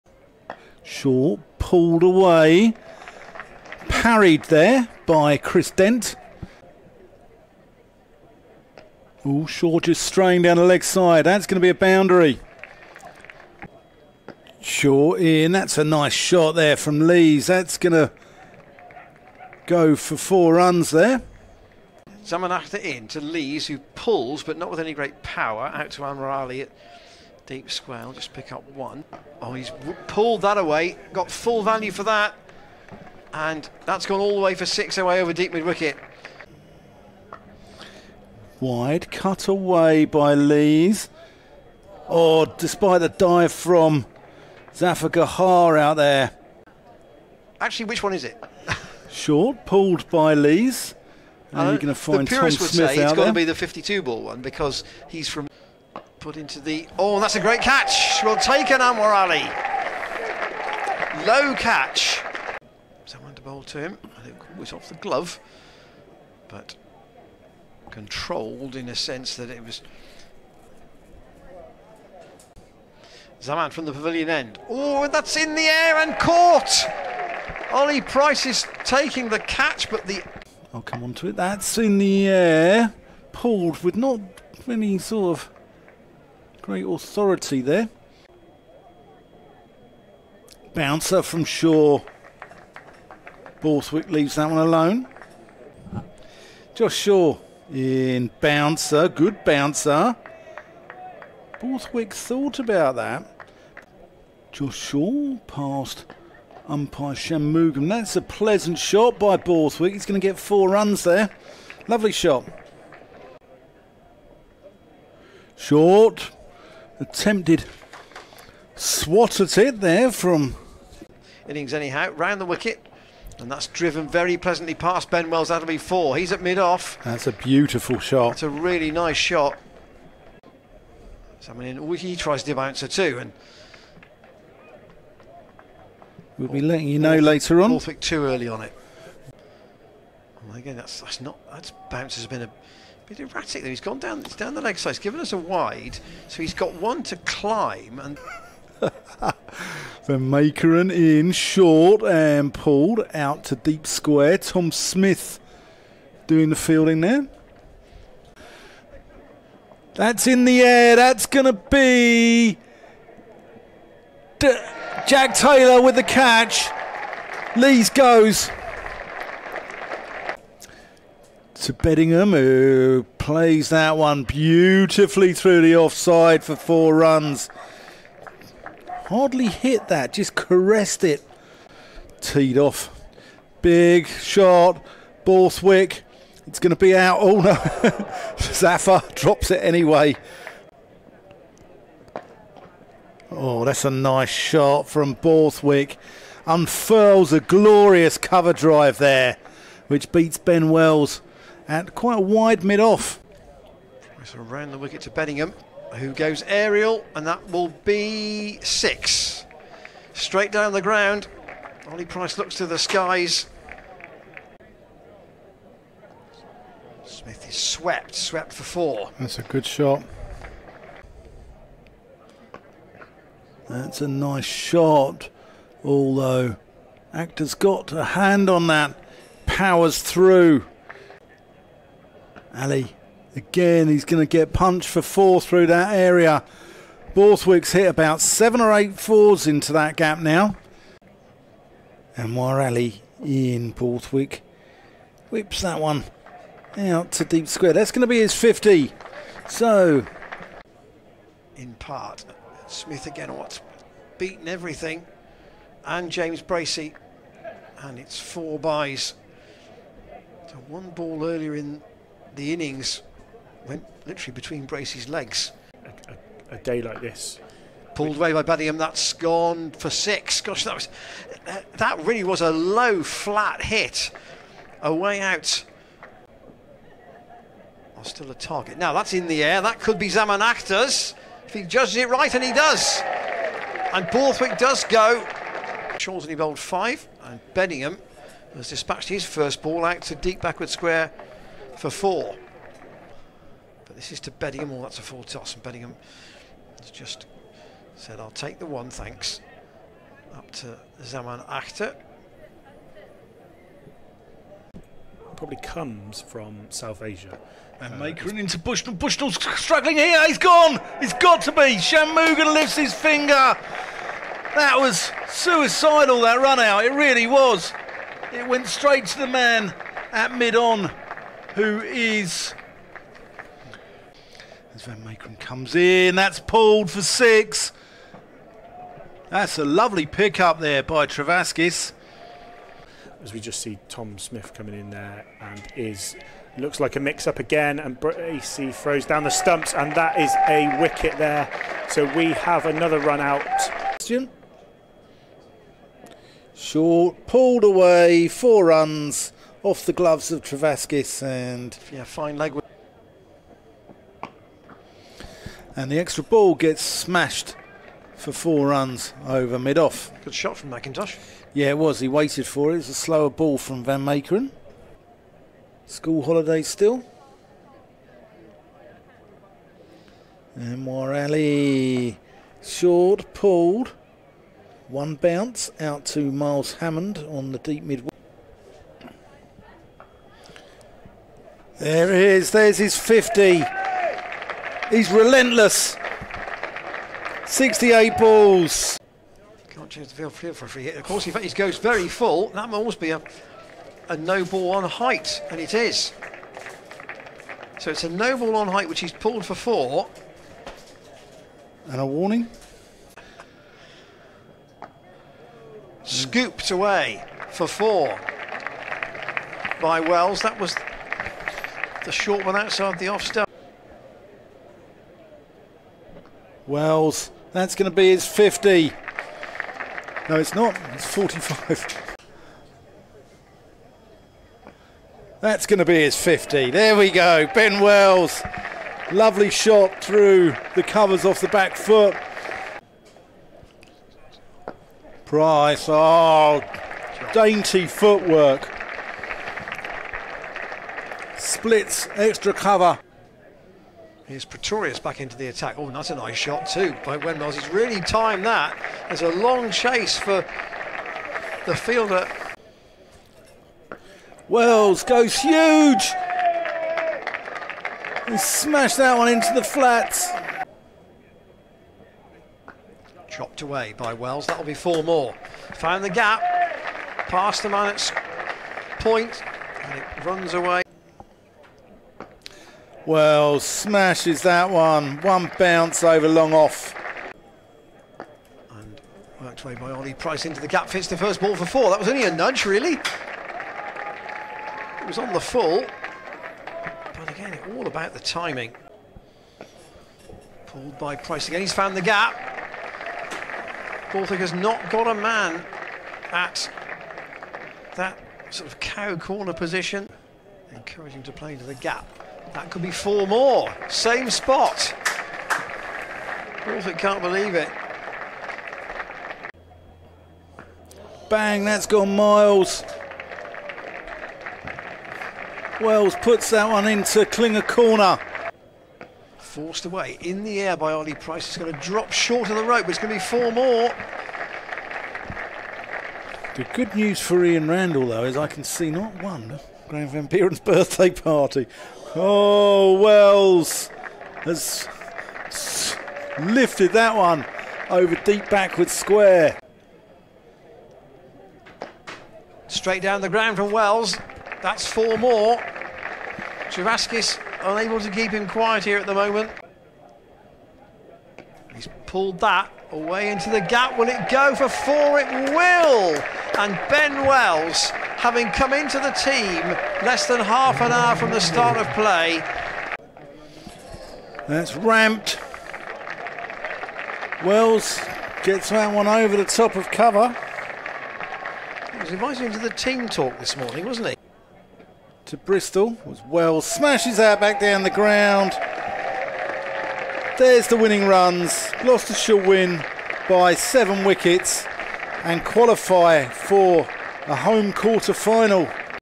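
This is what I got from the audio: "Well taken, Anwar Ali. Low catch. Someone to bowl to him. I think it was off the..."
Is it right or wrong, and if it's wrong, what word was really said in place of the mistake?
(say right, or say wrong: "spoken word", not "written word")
right.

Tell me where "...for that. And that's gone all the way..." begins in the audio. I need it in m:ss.
0:31.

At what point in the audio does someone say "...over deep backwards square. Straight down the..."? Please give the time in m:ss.
8:57.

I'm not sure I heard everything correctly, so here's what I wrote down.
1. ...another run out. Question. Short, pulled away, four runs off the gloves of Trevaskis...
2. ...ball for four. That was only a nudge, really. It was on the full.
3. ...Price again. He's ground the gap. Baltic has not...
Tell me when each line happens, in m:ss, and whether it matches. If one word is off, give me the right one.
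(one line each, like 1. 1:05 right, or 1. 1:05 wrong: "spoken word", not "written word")
1. 5:42 right
2. 8:01 right
3. 8:11 wrong: "found", not "ground".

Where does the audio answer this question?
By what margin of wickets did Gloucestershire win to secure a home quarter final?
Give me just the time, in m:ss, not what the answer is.
9:43.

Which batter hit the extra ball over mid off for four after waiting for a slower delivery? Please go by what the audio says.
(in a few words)
Mackintosh.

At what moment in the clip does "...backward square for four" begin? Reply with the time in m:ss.
4:50.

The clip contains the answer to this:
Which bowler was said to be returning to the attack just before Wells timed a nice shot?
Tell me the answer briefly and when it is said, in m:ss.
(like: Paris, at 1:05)
Pretorius, at 7:24.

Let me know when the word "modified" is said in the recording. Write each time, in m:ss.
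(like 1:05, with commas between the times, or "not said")
not said.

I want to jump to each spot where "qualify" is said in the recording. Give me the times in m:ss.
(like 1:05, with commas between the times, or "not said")
9:45.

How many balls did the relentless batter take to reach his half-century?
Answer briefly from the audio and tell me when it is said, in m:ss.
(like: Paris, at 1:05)
68, at 6:27.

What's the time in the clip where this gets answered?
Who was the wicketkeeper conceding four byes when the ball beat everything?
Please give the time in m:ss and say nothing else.
4:16.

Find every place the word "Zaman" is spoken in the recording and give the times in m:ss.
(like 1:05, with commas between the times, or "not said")
0:22, 1:13, 4:40, 5:01.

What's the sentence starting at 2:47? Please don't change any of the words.
Lees goes to Bedingham, who plays that one beautifully through the offside for four runs.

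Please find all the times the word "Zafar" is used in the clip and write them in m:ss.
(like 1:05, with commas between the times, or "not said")
0:44, 3:08.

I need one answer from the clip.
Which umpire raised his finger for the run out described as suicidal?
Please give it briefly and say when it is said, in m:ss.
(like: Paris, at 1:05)
Shamugan, at 5:11.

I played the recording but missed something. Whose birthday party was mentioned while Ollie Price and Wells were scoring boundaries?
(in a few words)
Graeme Van Buuren.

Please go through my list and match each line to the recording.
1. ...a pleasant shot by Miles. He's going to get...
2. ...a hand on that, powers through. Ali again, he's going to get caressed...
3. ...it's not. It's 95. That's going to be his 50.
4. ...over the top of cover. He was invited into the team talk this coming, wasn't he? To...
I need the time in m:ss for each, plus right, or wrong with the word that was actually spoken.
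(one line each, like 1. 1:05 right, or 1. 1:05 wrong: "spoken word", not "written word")
1. 1:48 wrong: "Borthwick", not "Miles"
2. 3:47 wrong: "punched", not "caressed"
3. 7:00 wrong: "45", not "95"
4. 9:29 wrong: "morning", not "coming".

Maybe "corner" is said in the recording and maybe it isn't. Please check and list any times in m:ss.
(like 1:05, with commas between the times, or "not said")
8:19, 8:37.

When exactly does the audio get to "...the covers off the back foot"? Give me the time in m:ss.
7:10.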